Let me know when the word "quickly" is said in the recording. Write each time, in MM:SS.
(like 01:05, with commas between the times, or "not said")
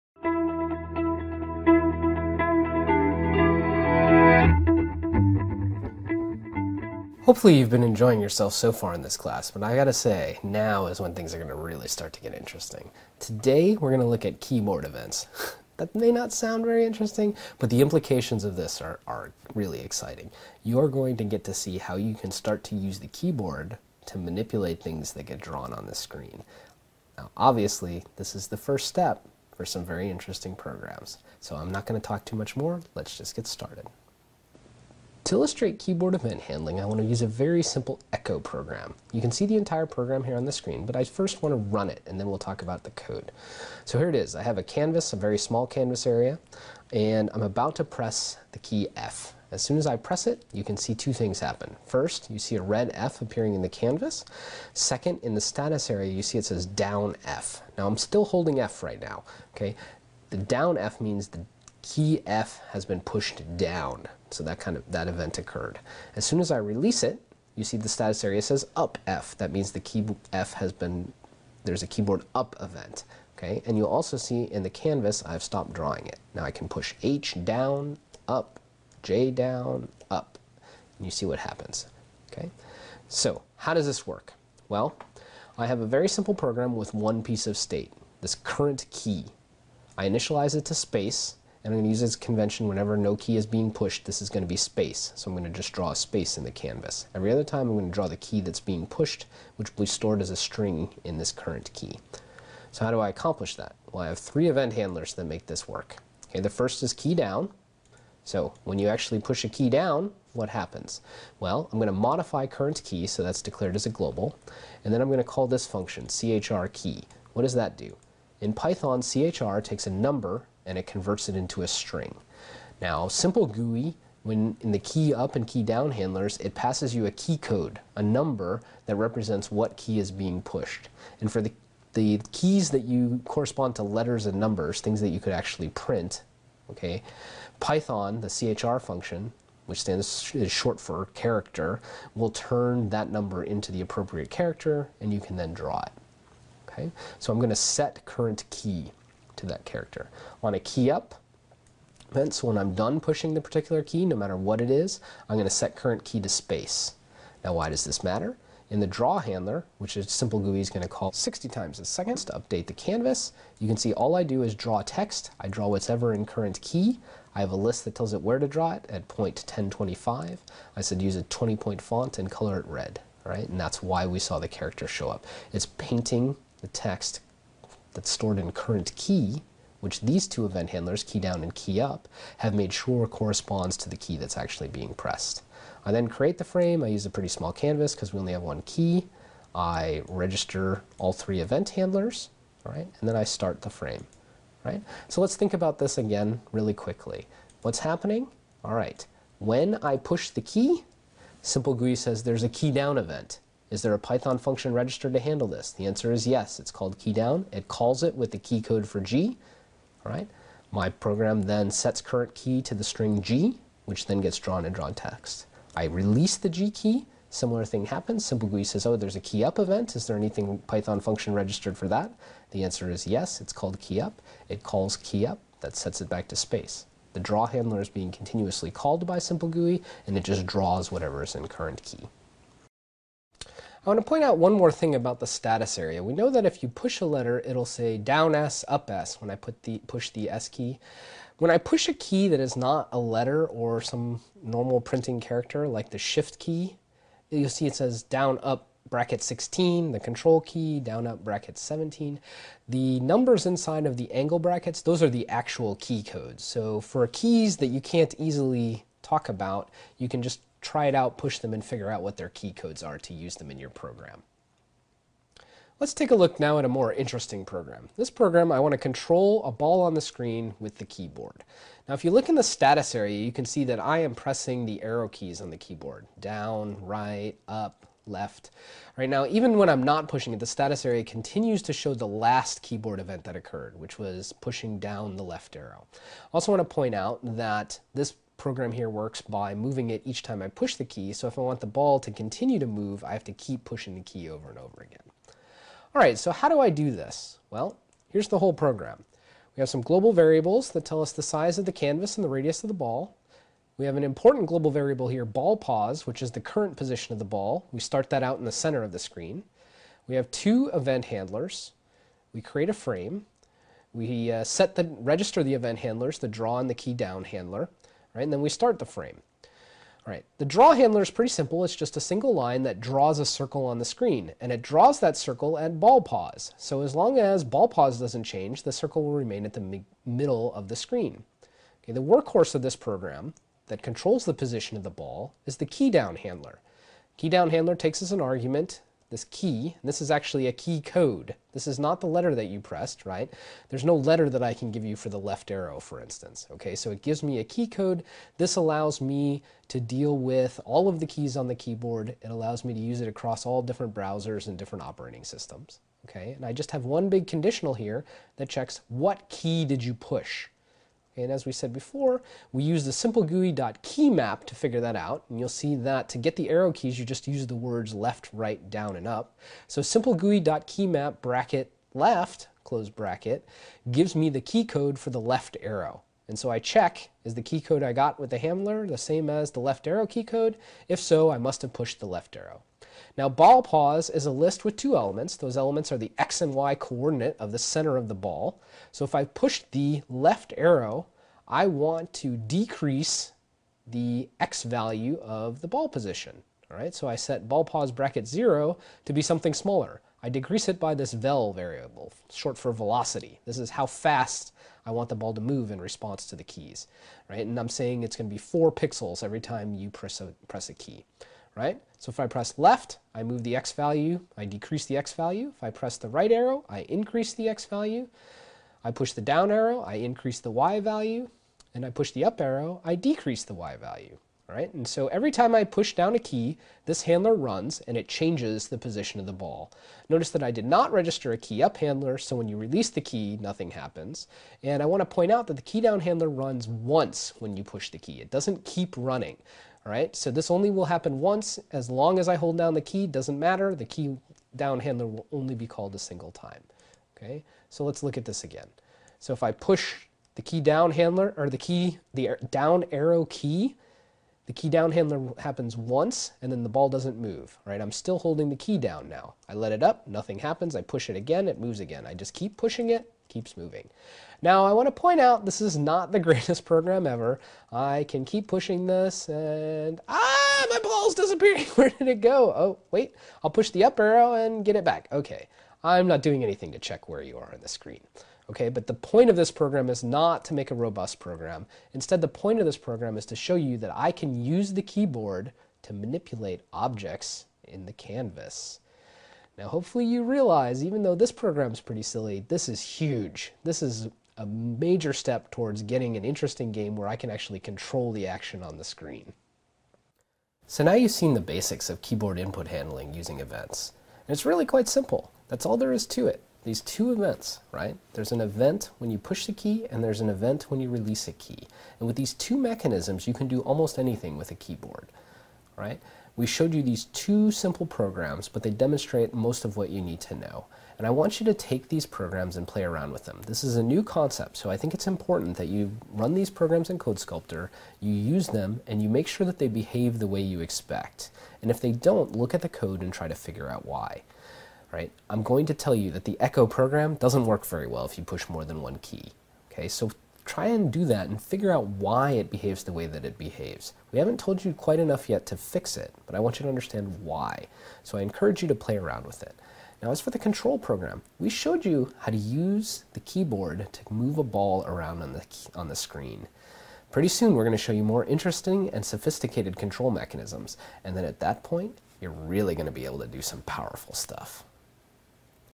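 03:16.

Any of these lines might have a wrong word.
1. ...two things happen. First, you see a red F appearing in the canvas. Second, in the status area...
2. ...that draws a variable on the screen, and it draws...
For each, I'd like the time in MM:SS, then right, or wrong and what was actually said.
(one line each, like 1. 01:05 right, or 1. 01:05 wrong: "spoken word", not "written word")
1. 00:50 right
2. 05:22 wrong: "circle", not "variable".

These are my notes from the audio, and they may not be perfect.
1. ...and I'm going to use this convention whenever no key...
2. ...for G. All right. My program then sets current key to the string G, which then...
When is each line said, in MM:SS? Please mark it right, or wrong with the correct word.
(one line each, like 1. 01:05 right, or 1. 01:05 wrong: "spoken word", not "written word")
1. 01:31 right
2. 03:28 right.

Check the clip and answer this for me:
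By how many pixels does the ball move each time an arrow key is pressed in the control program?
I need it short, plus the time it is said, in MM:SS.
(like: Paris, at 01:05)
4, at 06:48.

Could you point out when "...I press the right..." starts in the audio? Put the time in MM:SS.
06:55.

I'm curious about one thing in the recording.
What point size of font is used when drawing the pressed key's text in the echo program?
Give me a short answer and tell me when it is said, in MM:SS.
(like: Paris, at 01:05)
20, at 02:51.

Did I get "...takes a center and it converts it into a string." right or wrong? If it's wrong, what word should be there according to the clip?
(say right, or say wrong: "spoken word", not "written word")
wrong: "number", not "center".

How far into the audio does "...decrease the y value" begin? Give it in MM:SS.
07:02.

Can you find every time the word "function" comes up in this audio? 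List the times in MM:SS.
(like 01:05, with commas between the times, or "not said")
01:55, 02:18, 03:24, 03:40.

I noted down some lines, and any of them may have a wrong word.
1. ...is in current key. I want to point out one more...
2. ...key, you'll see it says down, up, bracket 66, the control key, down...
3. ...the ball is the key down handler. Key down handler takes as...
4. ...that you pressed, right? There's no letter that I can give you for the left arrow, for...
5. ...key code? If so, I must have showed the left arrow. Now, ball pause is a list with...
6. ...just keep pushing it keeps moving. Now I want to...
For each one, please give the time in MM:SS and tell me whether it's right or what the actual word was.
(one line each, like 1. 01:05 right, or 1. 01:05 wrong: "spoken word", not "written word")
1. 03:51 right
2. 04:06 wrong: "16", not "66"
3. 05:34 right
4. 05:42 right
5. 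06:20 wrong: "pushed", not "showed"
6. 07:42 right.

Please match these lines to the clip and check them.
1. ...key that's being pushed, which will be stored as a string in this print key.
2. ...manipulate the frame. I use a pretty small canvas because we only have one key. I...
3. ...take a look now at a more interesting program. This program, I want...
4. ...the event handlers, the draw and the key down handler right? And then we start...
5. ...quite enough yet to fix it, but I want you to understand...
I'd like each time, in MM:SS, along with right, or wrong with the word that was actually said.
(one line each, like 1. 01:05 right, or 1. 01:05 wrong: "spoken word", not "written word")
1. 01:38 wrong: "current", not "print"
2. 03:06 wrong: "create", not "manipulate"
3. 04:25 right
4. 05:15 right
5. 09:04 right.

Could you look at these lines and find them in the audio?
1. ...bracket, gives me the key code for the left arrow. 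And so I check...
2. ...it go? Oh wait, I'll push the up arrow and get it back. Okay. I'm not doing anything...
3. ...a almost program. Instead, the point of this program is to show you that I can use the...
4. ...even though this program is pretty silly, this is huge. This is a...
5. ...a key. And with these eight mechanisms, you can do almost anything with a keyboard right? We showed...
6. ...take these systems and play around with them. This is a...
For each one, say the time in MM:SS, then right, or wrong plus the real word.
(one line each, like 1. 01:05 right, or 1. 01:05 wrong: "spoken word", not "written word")
1. 06:12 right
2. 07:52 right
3. 08:00 wrong: "robust", not "almost"
4. 08:10 right
5. 08:31 wrong: "two", not "eight"
6. 08:41 wrong: "programs", not "systems".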